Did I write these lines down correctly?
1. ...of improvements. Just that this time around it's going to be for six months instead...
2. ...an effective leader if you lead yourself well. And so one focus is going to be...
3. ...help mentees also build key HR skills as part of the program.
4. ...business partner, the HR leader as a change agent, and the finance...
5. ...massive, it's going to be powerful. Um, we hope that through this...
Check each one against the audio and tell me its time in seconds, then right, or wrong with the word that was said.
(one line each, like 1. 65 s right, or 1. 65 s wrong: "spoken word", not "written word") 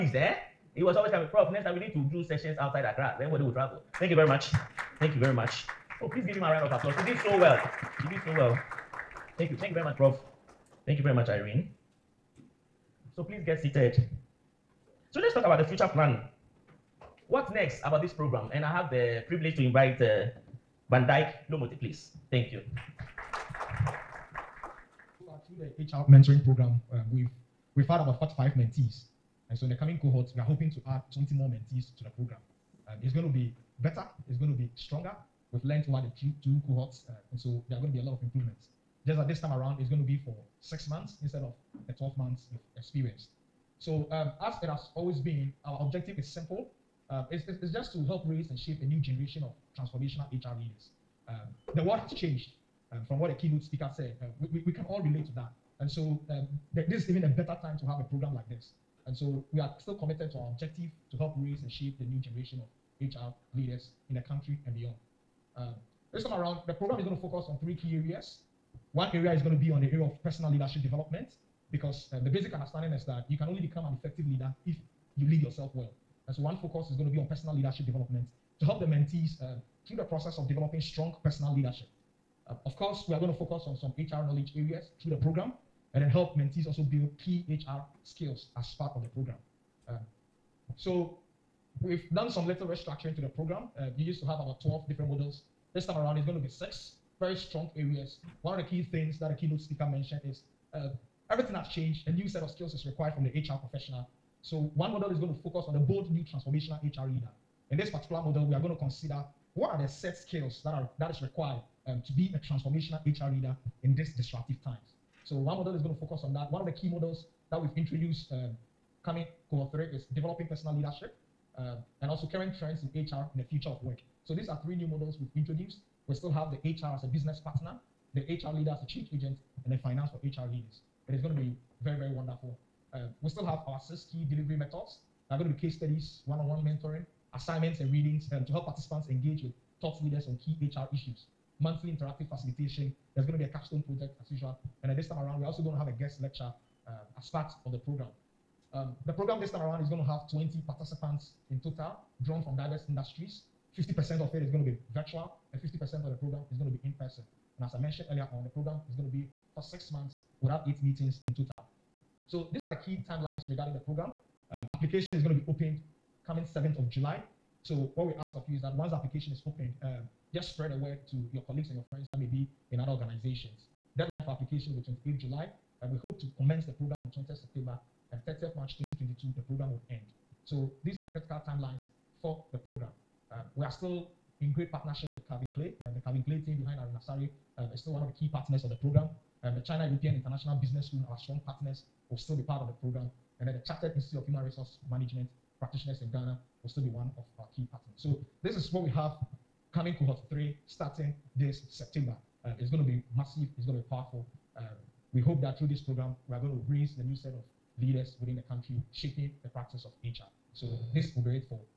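1. 38 s right
2. 73 s right
3. 86 s right
4. 127 s right
5. 203 s right.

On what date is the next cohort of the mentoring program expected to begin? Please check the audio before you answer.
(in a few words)
20 September.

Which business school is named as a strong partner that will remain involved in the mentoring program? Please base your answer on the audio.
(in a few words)
China European International Business School.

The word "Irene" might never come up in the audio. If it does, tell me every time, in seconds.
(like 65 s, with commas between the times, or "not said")
11 s, 186 s.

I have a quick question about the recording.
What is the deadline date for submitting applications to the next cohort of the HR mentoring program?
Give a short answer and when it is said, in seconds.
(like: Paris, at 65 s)
28 July, at 175 s.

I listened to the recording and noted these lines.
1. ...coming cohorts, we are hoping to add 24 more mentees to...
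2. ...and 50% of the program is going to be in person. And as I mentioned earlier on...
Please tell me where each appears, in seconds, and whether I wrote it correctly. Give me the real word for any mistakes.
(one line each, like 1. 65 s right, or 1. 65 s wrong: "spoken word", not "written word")
1. 29 s wrong: "20", not "24"
2. 155 s right.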